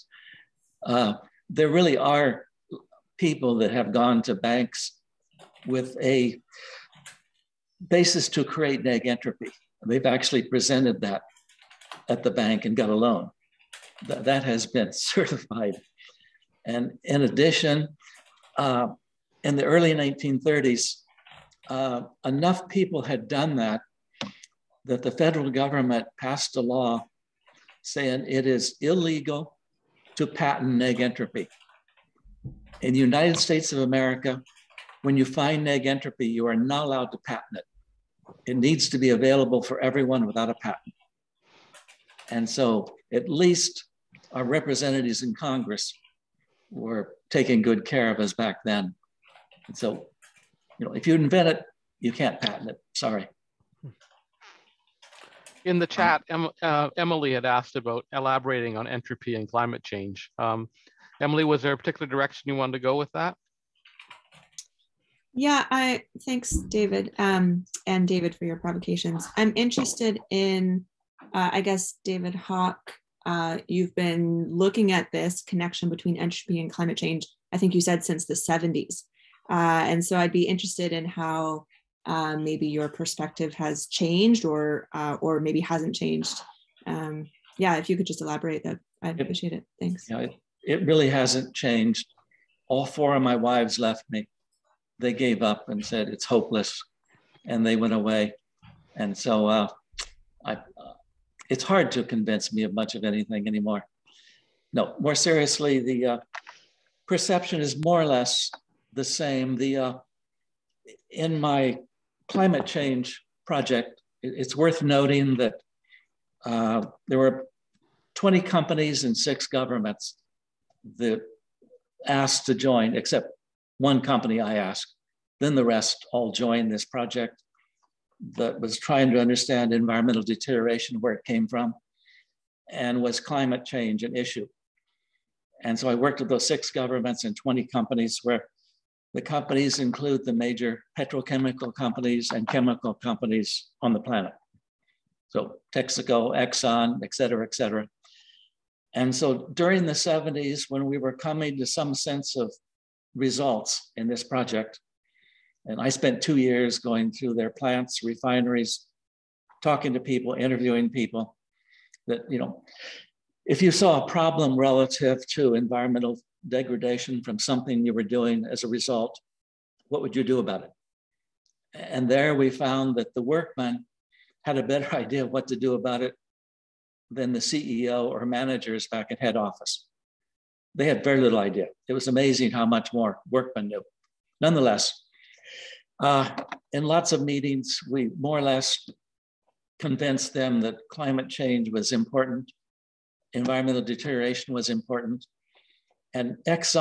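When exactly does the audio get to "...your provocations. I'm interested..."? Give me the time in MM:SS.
01:08.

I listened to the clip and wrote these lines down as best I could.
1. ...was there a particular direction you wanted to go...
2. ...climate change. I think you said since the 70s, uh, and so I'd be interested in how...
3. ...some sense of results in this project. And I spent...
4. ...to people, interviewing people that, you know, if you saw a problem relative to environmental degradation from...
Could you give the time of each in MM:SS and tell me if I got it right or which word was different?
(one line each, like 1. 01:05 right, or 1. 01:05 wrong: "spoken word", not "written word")
1. 01:01 right
2. 01:16 right
3. 02:31 right
4. 02:39 right.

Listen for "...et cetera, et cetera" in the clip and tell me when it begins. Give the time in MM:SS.
02:27.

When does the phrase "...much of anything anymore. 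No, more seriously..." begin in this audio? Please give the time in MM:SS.
01:42.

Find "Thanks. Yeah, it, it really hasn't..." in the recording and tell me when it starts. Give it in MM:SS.
01:29.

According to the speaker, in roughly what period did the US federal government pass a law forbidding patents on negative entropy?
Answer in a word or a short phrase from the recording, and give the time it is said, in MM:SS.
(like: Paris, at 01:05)
early 1930s, at 00:19.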